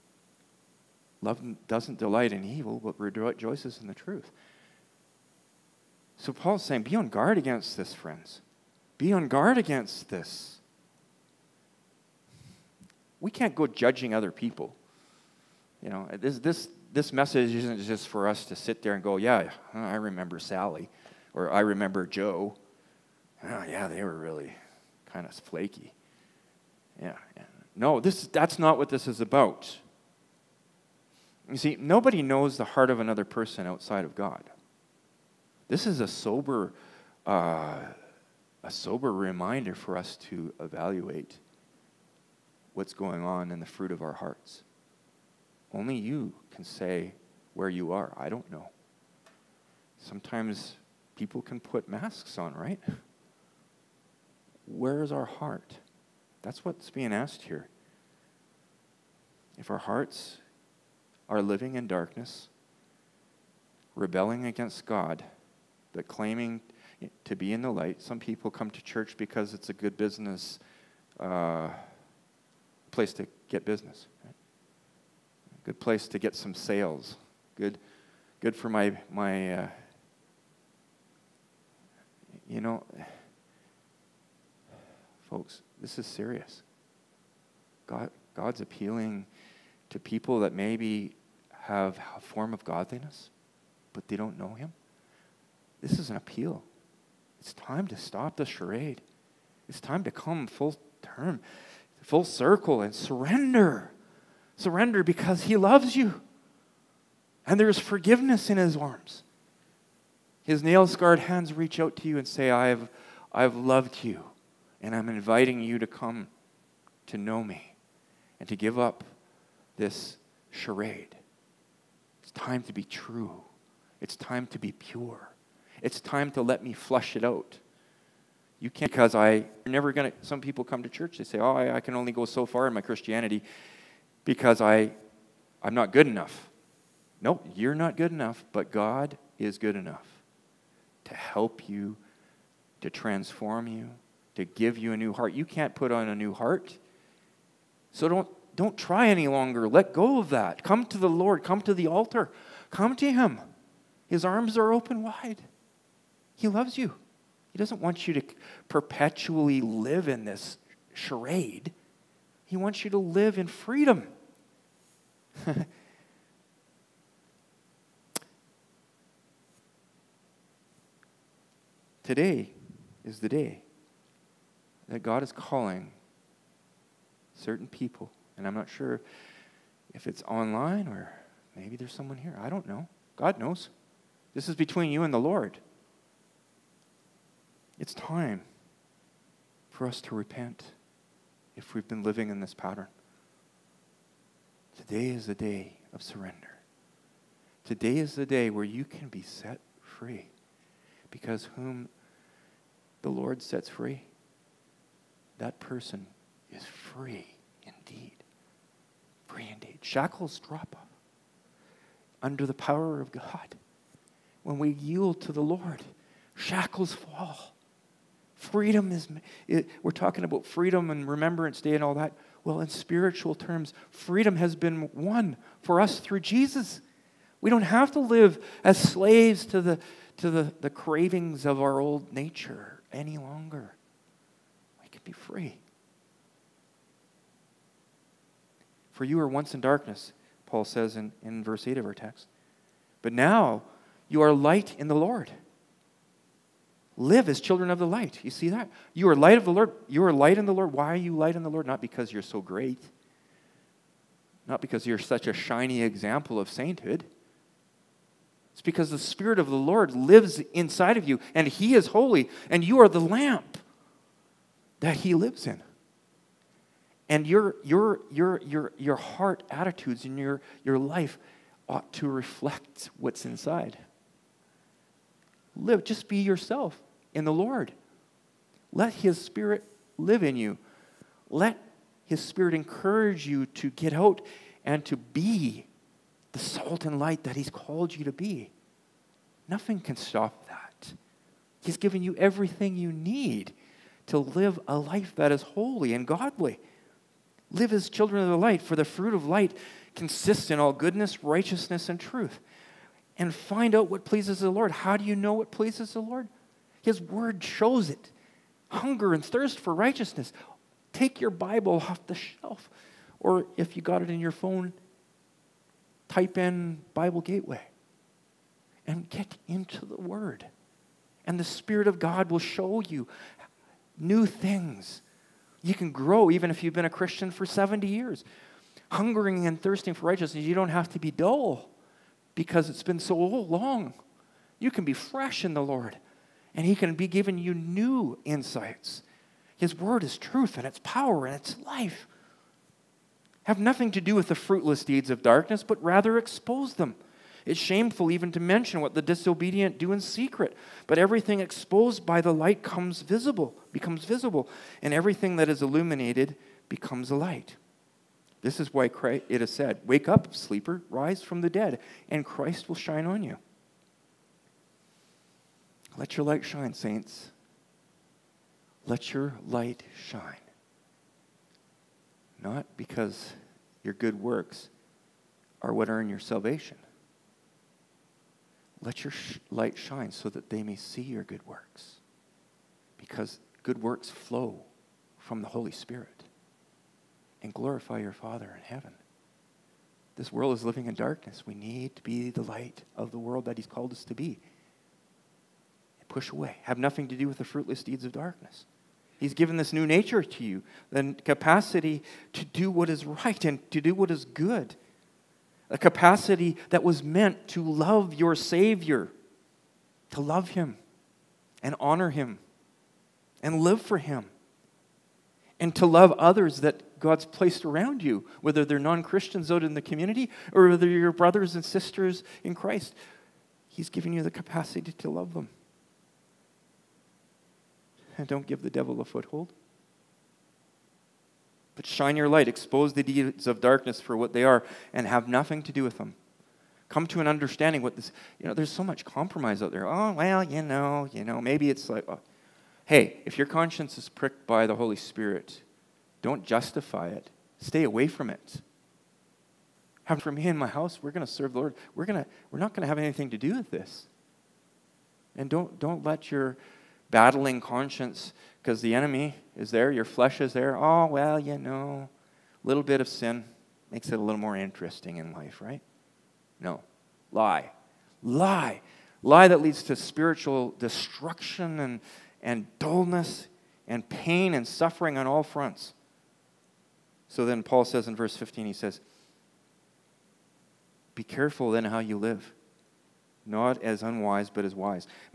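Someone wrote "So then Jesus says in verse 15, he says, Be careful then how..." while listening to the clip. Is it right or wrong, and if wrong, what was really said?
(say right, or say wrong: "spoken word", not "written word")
wrong: "Paul", not "Jesus".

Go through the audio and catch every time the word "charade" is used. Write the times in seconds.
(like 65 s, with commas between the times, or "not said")
98 s, 120 s, 160 s.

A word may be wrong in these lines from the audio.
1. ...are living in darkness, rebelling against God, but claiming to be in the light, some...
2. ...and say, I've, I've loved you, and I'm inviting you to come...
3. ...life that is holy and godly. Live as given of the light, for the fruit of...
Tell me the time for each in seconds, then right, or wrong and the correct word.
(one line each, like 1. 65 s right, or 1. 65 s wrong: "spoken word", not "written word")
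1. 61 s right
2. 112 s right
3. 294 s wrong: "children", not "given".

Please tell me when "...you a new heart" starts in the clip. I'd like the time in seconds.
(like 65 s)
144 s.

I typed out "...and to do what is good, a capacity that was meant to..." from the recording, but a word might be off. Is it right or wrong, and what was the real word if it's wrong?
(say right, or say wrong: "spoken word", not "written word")
right.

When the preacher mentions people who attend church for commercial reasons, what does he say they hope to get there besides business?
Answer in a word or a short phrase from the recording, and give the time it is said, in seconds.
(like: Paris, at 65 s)
Sales, at 76 s.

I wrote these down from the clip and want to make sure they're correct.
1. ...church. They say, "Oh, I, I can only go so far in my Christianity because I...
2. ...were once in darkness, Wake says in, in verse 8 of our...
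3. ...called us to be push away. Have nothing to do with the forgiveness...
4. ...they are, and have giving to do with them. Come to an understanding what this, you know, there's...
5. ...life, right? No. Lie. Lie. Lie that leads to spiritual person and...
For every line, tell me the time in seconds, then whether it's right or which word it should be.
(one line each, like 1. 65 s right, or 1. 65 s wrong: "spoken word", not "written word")
1. 130 s right
2. 239 s wrong: "Paul", not "Wake"
3. 393 s wrong: "fruitless", not "forgiveness"
4. 434 s wrong: "nothing", not "giving"
5. 465 s wrong: "destruction", not "person".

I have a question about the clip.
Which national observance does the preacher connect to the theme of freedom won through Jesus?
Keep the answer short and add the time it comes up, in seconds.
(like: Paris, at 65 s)
Remembrance Day, at 221 s.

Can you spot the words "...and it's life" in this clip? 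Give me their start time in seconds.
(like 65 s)
341 s.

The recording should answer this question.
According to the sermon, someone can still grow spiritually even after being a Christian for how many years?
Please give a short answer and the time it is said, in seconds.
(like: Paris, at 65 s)
70, at 327 s.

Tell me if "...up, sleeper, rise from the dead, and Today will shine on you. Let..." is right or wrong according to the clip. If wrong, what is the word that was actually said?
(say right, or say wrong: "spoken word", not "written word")
wrong: "Christ", not "Today".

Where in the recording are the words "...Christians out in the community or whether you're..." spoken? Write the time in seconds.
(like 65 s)
419 s.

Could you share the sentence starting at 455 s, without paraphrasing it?
And don't, don't let your battling conscience because the enemy is there, your flesh is there.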